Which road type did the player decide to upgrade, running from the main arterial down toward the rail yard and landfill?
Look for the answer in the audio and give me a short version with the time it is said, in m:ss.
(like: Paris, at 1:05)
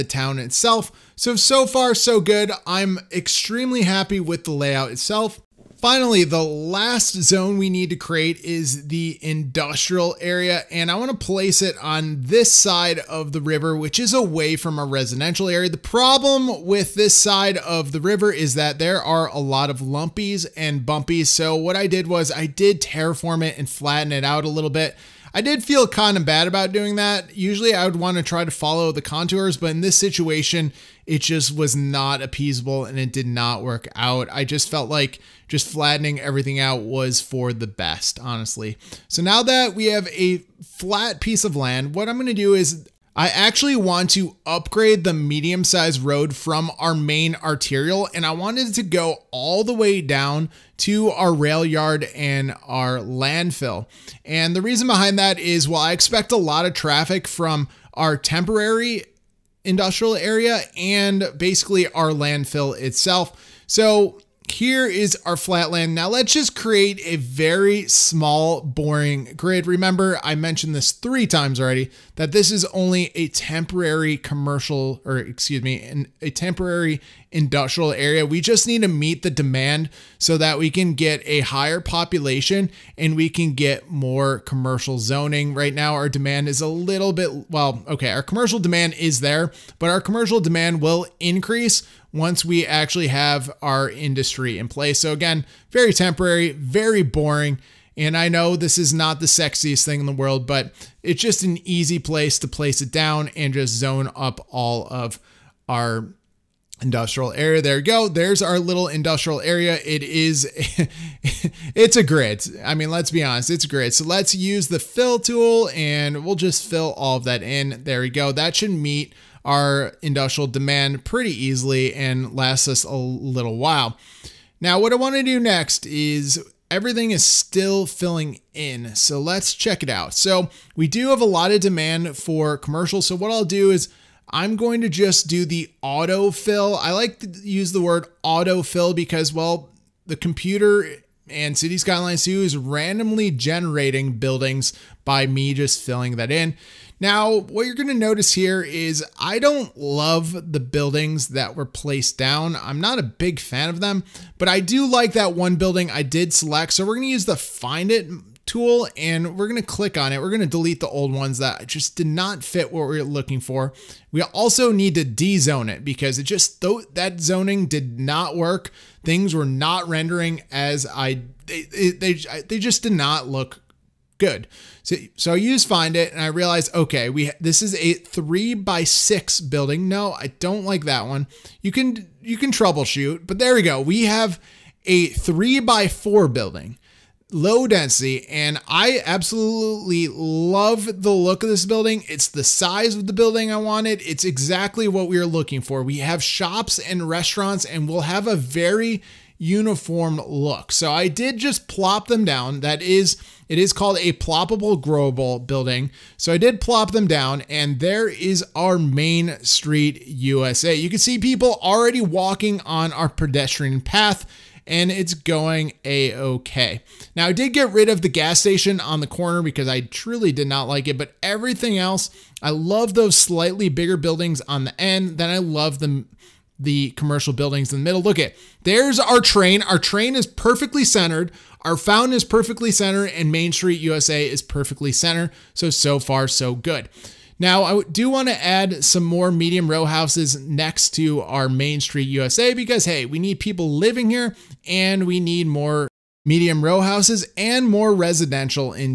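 Medium sized road, at 0:45.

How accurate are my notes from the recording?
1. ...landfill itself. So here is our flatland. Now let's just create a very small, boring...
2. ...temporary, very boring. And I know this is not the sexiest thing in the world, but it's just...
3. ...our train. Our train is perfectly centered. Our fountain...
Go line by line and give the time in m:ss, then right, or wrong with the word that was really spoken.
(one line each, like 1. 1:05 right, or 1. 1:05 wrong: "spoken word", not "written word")
1. 1:02 right
2. 1:35 right
3. 3:48 right.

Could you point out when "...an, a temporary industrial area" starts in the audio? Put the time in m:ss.
1:15.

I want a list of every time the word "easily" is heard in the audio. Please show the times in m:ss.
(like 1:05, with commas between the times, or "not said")
2:01.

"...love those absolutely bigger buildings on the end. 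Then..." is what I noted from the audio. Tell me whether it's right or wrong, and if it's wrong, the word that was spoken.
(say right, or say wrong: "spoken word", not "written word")
wrong: "slightly", not "absolutely".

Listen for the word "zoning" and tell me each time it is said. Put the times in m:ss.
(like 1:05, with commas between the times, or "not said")
1:24, 2:47.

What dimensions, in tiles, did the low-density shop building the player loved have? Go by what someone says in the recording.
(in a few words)
3 by 4.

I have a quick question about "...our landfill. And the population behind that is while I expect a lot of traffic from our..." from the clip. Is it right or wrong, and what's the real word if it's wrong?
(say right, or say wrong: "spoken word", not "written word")
wrong: "reason", not "population".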